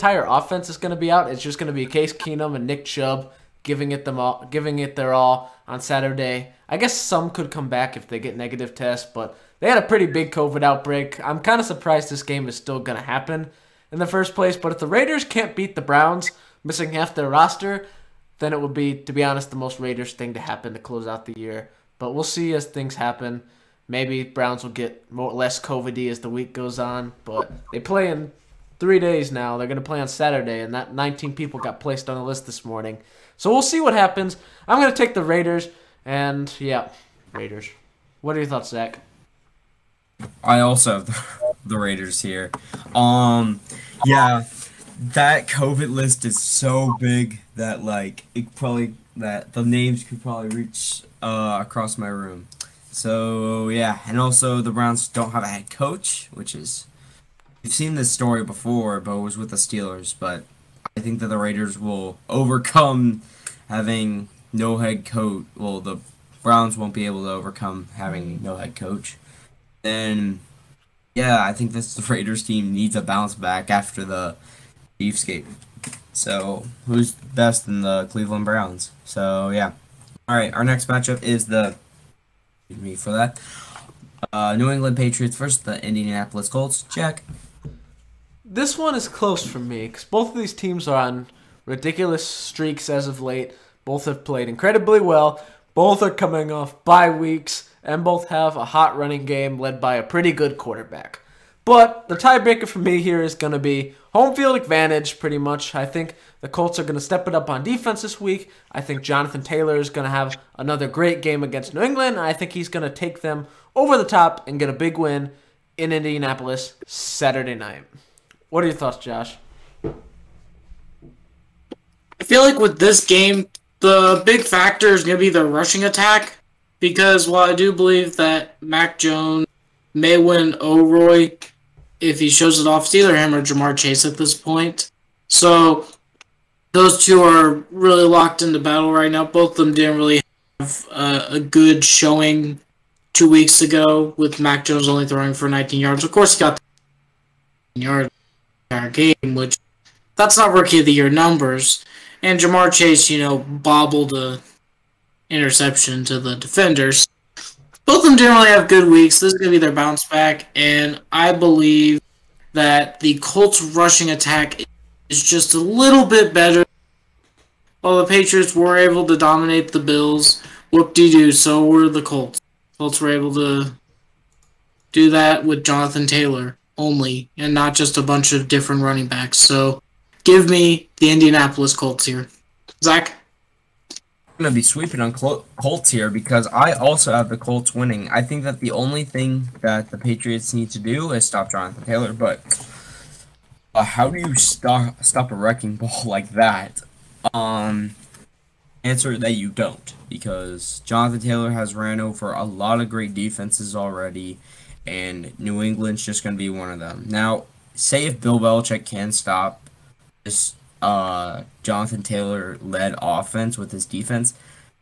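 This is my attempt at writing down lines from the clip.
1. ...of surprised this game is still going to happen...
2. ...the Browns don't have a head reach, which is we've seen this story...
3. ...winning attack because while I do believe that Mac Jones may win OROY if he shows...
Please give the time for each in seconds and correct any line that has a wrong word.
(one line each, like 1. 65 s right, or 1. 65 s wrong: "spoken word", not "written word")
1. 11 s right
2. 54 s wrong: "coach", not "reach"
3. 125 s wrong: "rushing", not "winning".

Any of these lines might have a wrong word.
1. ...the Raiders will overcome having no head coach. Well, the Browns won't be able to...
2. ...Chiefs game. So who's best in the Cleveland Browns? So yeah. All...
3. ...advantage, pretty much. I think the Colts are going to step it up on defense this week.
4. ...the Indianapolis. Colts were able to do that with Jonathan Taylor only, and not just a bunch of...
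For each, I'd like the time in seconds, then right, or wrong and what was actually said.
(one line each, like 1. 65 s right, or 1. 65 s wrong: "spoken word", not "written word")
1. 61 s right
2. 74 s right
3. 104 s right
4. 171 s wrong: "Colts", not "Indianapolis".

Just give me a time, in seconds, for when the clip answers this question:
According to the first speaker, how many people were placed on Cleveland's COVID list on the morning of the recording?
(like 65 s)
30 s.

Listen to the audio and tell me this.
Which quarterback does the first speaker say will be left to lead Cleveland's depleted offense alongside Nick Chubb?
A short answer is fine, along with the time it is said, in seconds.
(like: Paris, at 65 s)
Case Keenum, at 1 s.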